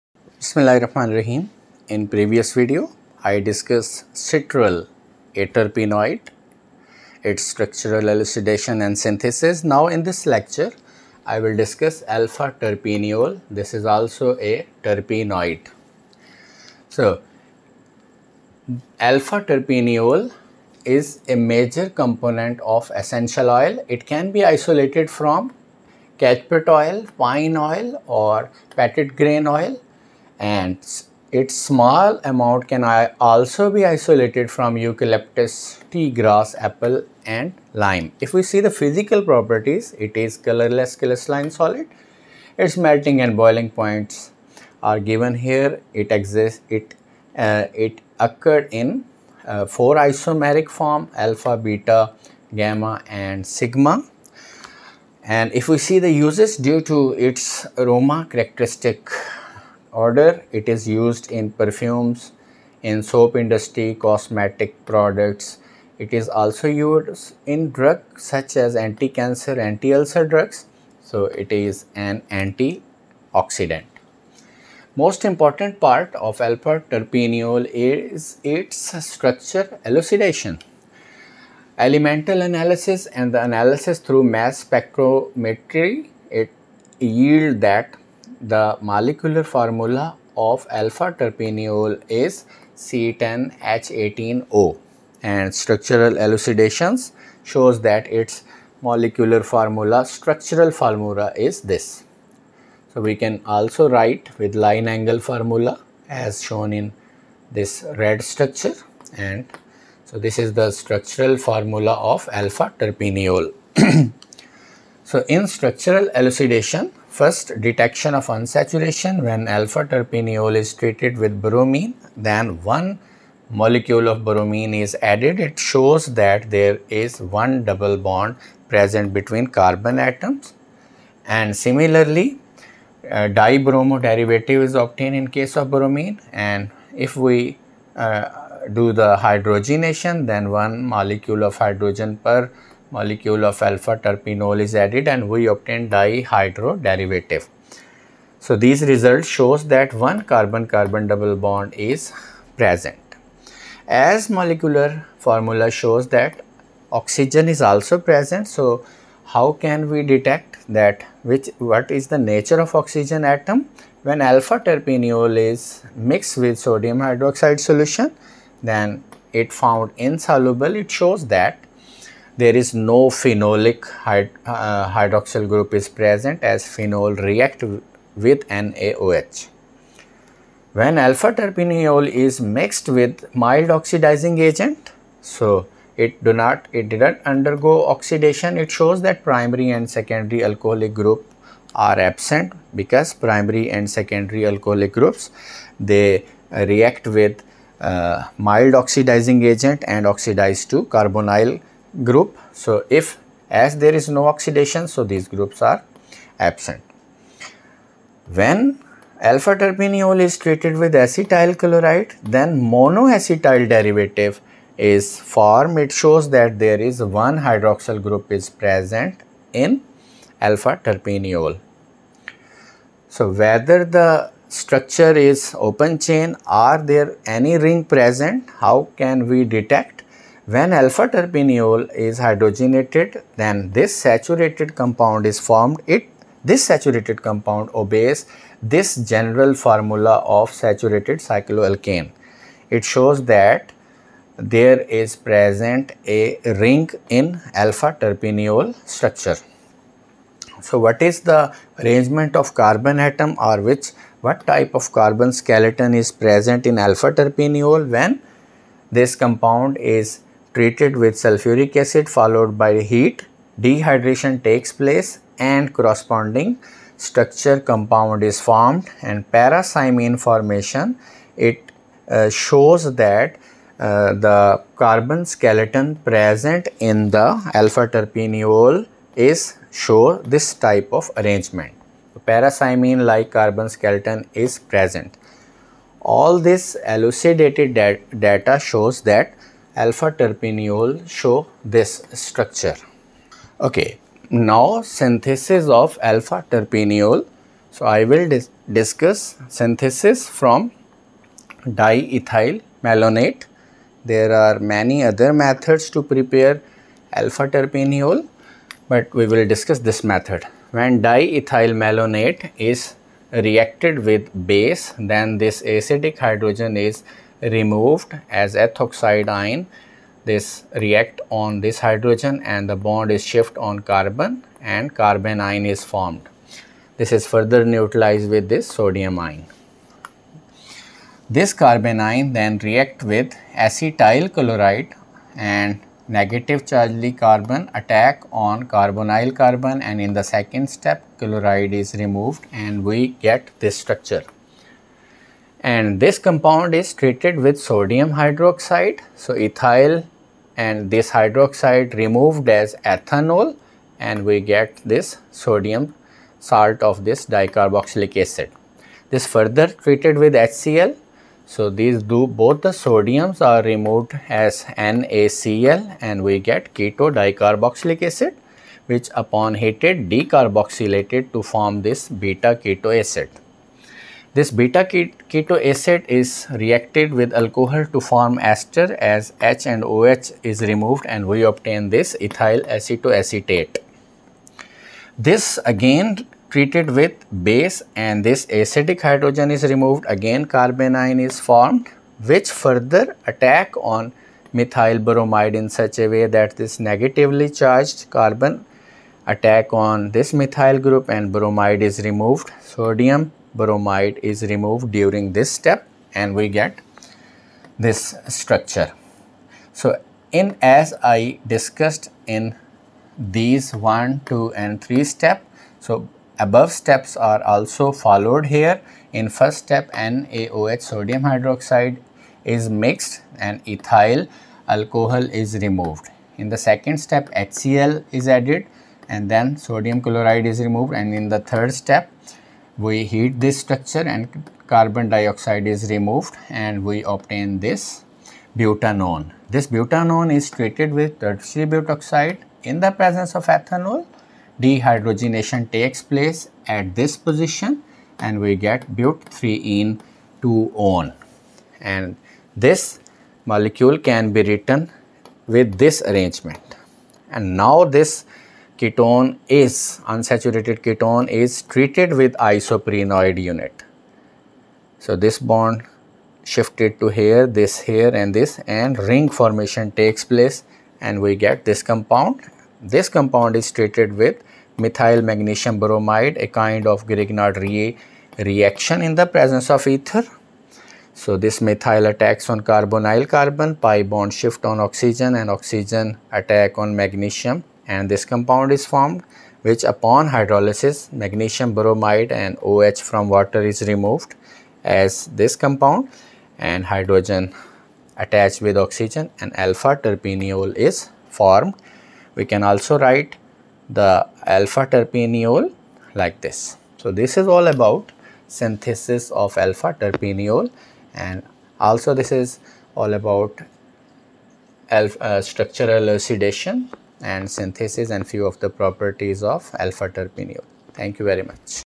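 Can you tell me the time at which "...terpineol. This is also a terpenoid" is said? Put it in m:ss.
0:12.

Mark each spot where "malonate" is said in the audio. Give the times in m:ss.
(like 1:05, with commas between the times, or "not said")
5:02, 5:11.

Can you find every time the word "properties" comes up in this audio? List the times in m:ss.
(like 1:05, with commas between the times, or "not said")
0:39, 8:38.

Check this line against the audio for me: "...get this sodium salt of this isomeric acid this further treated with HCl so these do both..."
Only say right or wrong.
wrong.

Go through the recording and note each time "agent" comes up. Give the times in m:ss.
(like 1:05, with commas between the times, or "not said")
3:04, 3:19.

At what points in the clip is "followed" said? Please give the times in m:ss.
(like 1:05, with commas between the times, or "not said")
4:22, 6:57.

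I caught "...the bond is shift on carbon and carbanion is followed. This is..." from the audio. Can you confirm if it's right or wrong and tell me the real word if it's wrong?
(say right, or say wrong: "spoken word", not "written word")
wrong: "formed", not "followed".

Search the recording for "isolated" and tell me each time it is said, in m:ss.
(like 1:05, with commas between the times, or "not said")
0:24, 0:33.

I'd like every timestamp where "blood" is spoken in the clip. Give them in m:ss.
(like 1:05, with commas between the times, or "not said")
not said.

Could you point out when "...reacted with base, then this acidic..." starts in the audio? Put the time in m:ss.
5:13.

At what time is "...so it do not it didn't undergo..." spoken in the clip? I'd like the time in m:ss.
3:05.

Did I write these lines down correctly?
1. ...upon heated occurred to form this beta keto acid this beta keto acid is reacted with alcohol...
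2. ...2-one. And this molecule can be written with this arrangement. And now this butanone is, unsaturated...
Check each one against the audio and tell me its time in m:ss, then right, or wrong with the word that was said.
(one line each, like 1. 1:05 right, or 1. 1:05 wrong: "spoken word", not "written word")
1. 6:09 wrong: "decarboxylated", not "occurred"
2. 7:30 wrong: "ketone", not "butanone".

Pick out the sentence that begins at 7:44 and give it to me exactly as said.
So this bond shifted to here, this here and this and ring formation takes place and we get this compound.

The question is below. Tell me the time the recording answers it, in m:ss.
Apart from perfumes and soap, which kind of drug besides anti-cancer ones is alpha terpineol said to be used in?
1:09.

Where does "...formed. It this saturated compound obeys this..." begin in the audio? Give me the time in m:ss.
3:55.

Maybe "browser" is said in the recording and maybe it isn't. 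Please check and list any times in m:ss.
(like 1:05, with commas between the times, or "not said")
not said.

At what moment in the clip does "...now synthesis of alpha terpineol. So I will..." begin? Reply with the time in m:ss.
4:54.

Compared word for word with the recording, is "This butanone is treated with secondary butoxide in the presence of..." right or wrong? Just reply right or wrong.
wrong.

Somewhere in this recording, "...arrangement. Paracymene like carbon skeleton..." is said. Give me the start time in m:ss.
4:41.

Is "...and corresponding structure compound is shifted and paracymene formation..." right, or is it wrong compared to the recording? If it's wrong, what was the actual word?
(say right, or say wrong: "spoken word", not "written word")
wrong: "formed", not "shifted".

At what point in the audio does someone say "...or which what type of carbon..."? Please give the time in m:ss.
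4:13.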